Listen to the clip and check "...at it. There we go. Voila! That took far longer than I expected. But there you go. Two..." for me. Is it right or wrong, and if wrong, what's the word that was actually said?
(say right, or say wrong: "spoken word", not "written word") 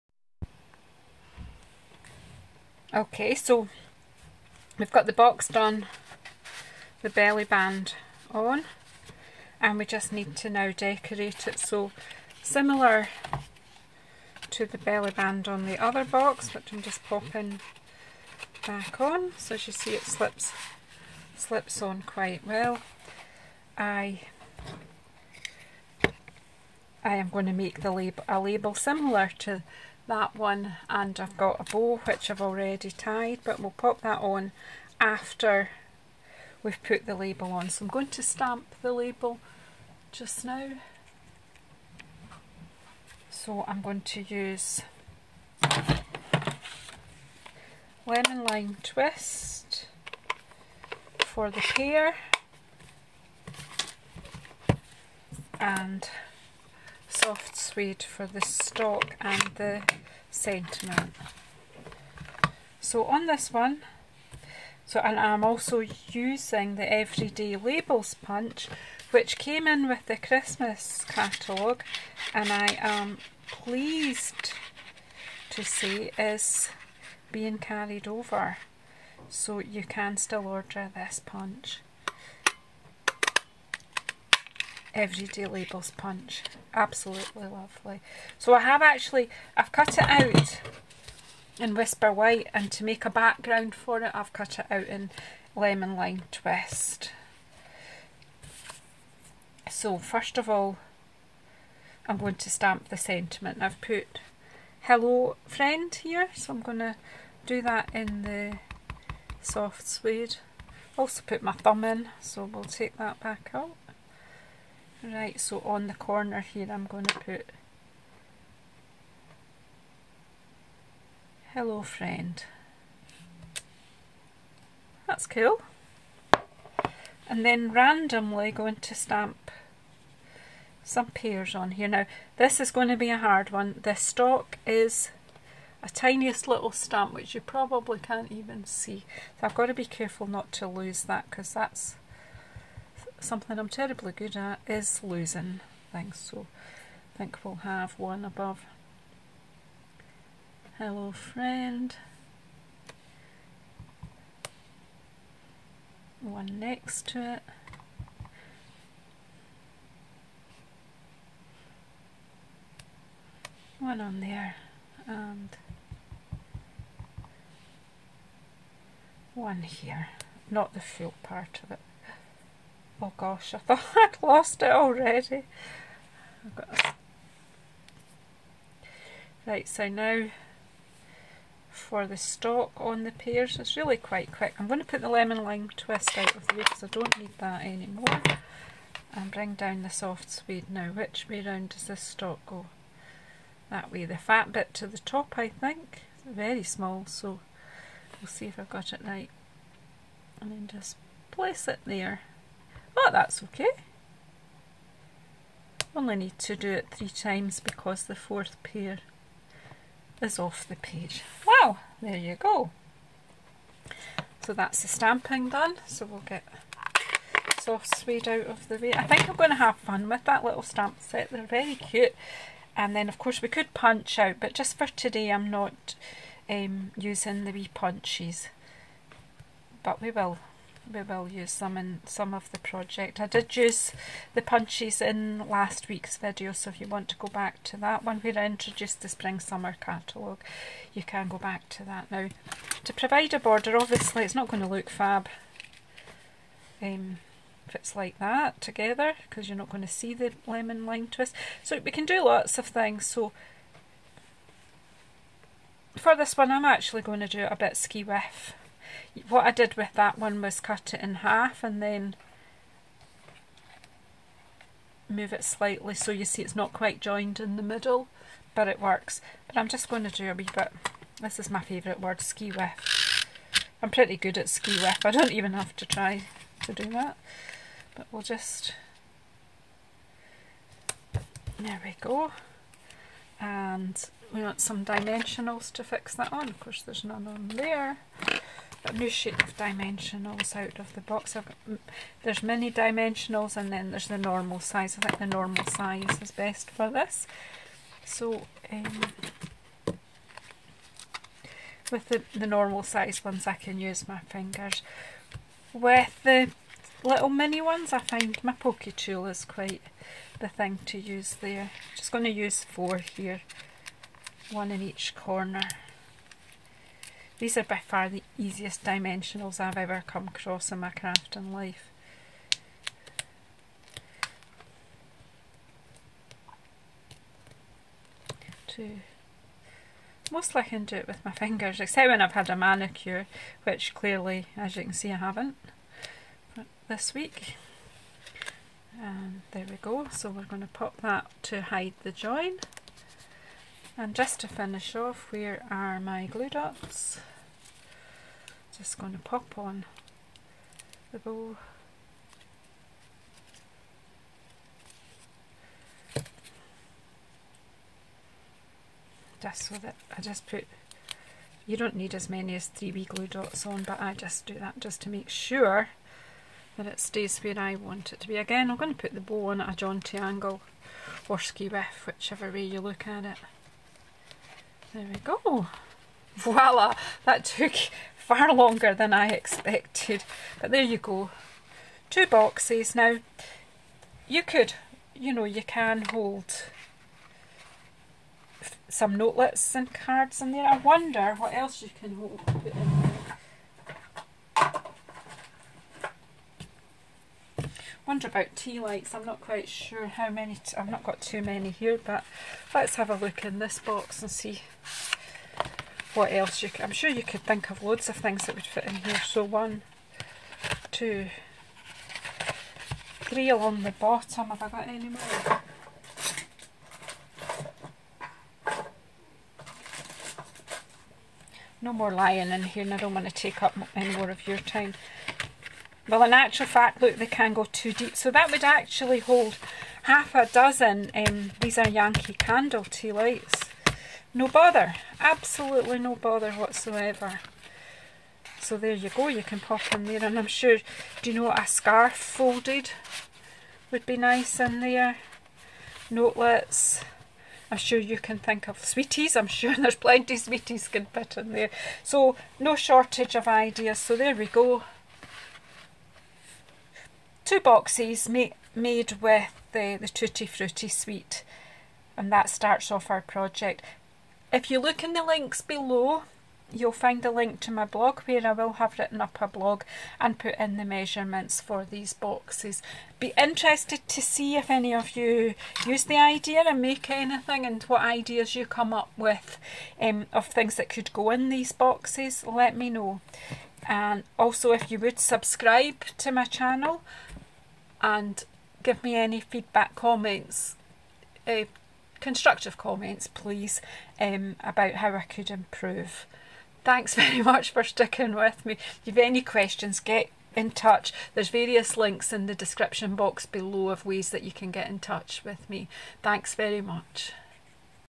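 right.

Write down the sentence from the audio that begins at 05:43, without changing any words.
And just to finish off, where are my glue dots?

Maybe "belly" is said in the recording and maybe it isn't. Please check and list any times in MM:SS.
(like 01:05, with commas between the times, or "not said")
00:07, 00:14.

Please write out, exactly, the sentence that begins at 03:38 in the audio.
I think I'm going to have fun with that little stamp set, they're very cute.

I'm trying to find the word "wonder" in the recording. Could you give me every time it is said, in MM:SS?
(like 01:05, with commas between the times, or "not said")
06:30, 06:38.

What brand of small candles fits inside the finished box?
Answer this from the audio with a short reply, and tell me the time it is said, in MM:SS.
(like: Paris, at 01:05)
Yankee Candle, at 07:11.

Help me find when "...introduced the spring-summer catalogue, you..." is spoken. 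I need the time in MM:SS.
03:58.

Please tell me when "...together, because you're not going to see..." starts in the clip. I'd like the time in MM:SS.
04:08.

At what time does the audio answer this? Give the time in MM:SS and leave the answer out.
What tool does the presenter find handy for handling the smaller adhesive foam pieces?
05:08.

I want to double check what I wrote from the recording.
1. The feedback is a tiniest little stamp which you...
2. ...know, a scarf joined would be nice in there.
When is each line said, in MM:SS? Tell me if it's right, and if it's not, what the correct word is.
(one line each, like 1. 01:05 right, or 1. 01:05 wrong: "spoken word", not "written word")
1. 02:13 wrong: "stock", not "feedback"
2. 07:21 wrong: "folded", not "joined".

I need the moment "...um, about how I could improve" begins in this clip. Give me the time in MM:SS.
08:14.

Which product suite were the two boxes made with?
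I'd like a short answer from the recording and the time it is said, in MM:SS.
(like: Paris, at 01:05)
Tutti Frutti, at 07:40.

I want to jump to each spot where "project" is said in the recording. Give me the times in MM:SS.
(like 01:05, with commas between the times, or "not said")
03:52, 07:43.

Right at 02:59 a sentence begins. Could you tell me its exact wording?
Right, so now for the stalk on the pears, it's really quite quick.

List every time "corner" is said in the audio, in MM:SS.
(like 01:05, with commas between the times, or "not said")
01:55, 05:15.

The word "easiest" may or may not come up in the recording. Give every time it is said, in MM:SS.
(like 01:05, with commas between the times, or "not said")
05:18.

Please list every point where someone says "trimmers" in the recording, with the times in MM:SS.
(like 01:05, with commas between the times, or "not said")
not said.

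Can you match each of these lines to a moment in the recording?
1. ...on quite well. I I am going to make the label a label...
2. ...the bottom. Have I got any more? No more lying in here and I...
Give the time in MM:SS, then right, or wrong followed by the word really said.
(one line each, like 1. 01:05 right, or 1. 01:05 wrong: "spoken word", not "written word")
1. 00:21 right
2. 06:53 right.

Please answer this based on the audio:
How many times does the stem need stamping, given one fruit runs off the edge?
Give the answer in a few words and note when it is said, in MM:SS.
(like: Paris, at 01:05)
3, at 03:26.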